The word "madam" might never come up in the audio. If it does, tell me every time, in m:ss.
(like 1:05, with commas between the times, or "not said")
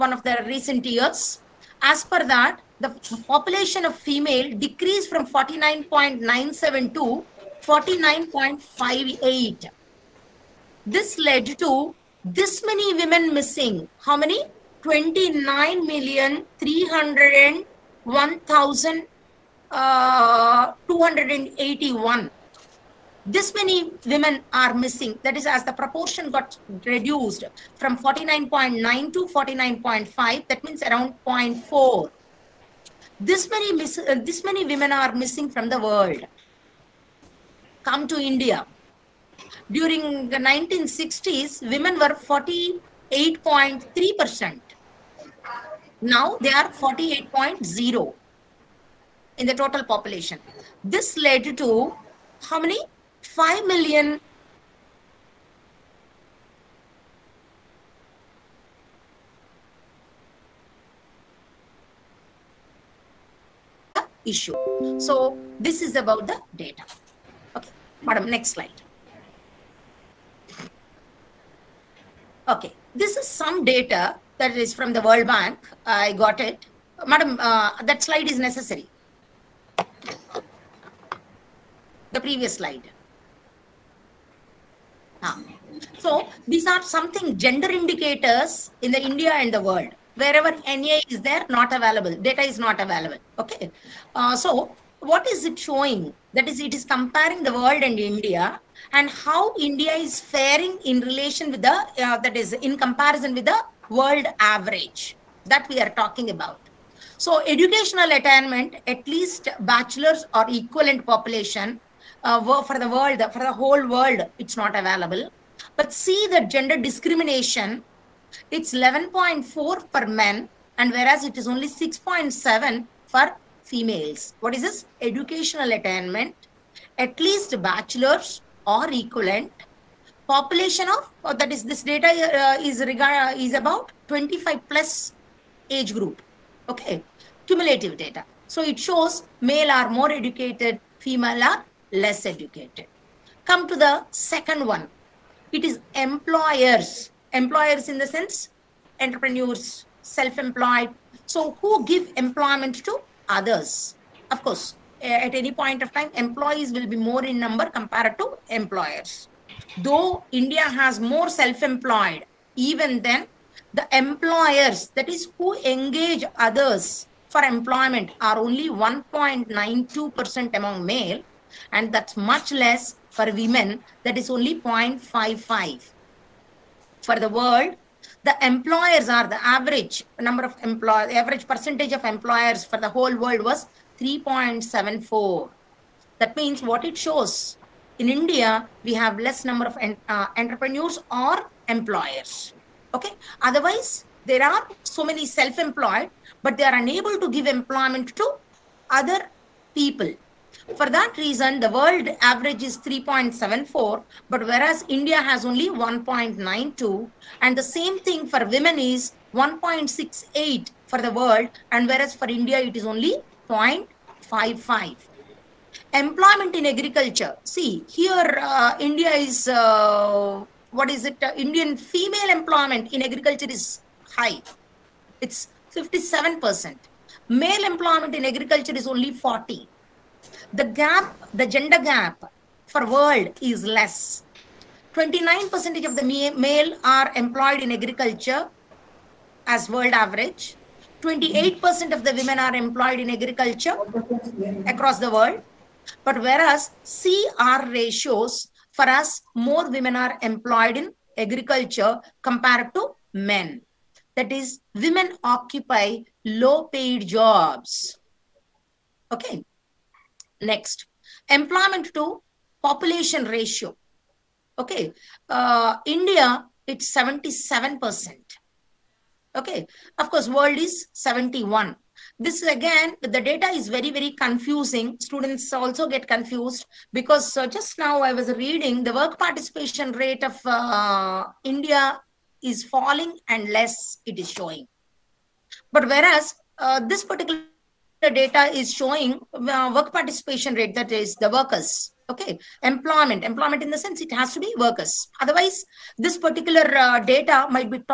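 1:08, 1:17.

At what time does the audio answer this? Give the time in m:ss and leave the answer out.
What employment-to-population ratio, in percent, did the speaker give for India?
4:26.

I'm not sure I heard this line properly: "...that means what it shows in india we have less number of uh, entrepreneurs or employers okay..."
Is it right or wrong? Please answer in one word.
right.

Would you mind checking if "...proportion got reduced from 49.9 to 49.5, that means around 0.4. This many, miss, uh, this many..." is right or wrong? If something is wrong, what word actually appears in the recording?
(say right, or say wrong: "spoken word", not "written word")
right.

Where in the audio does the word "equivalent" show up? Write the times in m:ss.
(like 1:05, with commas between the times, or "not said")
1:50, 2:08.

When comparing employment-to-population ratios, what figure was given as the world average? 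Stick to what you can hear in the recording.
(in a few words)
71.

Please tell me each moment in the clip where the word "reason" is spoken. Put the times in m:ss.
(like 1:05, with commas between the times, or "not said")
3:21.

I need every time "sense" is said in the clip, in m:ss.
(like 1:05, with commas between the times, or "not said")
2:28, 4:53.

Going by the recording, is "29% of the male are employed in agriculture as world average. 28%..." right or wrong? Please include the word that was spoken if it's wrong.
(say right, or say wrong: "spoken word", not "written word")
right.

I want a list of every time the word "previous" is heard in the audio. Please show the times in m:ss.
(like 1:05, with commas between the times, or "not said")
1:22.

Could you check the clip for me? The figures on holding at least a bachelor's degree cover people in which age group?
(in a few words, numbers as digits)
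25 plus.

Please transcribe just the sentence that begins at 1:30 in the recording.
Wherever NA is there, not available.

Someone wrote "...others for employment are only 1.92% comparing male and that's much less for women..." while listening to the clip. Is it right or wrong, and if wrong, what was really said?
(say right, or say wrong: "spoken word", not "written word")
wrong: "among", not "comparing".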